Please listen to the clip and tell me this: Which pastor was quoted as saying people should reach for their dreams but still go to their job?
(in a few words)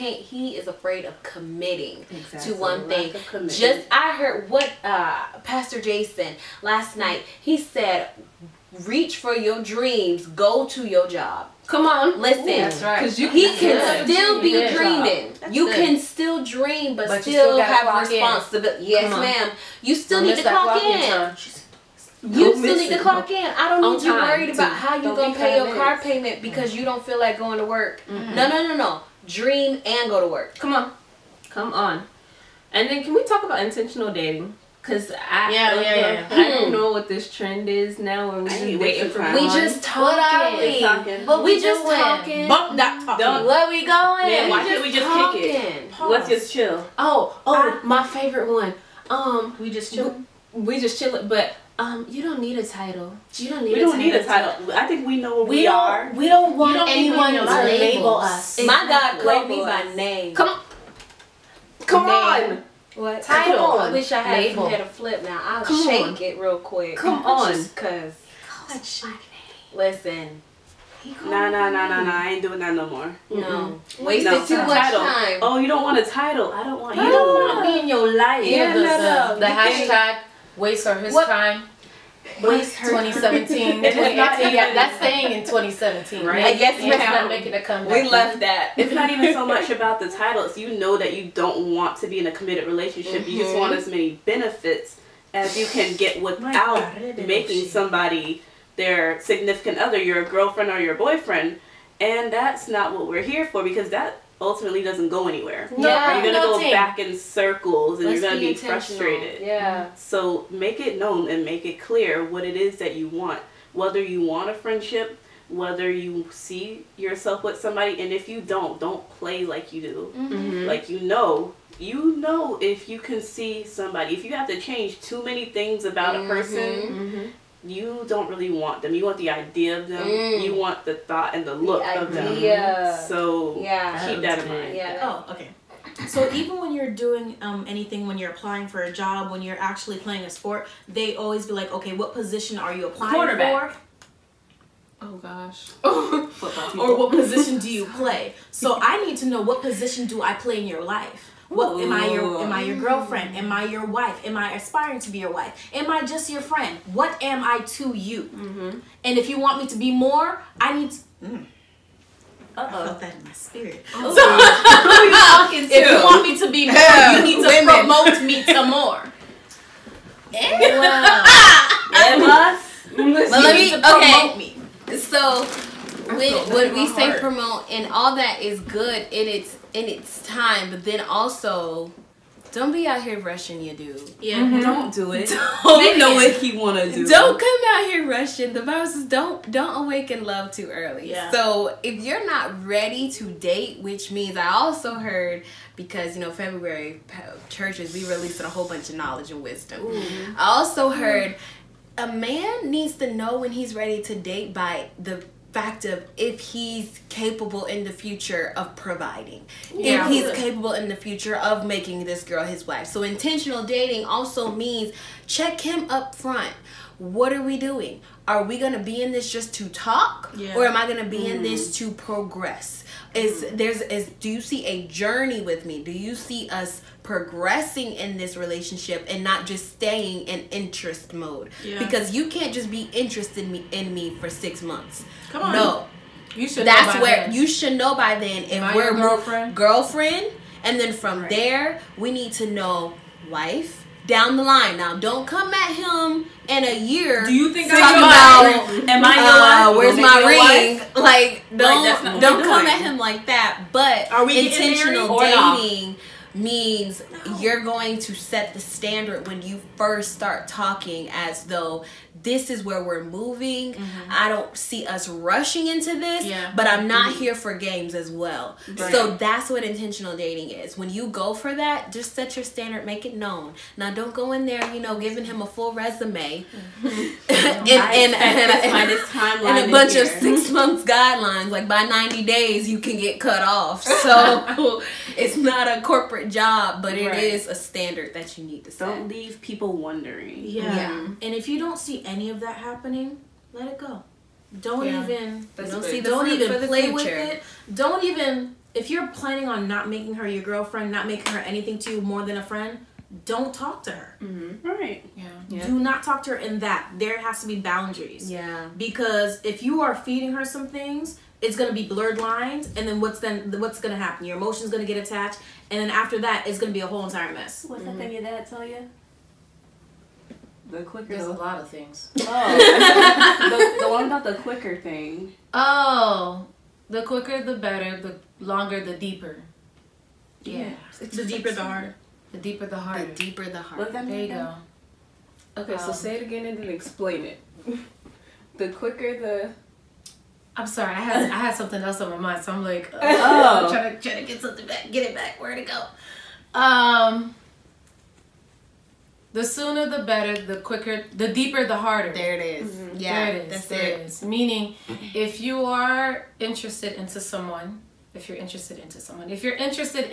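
Pastor Jason.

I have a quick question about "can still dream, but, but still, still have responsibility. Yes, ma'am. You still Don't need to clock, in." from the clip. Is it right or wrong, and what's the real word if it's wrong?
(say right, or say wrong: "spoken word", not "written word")
right.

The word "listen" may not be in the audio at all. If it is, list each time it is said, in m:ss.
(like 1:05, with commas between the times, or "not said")
0:12, 1:09.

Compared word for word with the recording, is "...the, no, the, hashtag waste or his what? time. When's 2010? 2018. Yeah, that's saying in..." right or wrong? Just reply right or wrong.
wrong.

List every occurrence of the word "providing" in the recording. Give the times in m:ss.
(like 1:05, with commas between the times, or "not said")
3:28.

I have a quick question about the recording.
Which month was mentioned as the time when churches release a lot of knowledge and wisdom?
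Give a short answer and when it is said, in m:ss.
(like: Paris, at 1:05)
February, at 3:16.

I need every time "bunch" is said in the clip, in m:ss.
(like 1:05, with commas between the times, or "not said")
3:18, 4:39.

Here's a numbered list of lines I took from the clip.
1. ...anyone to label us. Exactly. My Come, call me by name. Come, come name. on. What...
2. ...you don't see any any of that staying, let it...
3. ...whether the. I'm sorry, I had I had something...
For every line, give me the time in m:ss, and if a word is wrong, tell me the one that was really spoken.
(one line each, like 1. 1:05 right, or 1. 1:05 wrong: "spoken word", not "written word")
1. 0:56 wrong: "God", not "Come"
2. 4:51 wrong: "happening", not "staying"
3. 5:38 wrong: "quicker", not "whether".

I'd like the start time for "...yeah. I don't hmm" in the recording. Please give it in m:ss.
0:35.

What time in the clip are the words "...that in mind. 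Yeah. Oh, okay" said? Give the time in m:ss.
2:14.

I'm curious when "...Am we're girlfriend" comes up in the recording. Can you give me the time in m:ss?
3:58.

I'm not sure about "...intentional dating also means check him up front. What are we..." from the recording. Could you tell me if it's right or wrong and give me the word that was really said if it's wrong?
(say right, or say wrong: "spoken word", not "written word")
right.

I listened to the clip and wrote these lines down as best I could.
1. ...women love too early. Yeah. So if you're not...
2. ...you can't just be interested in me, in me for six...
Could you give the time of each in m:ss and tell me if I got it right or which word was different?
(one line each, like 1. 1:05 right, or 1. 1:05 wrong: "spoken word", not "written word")
1. 3:09 wrong: "awaken", not "women"
2. 3:52 right.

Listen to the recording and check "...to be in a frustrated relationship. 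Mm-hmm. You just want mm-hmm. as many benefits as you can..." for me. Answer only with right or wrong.
wrong.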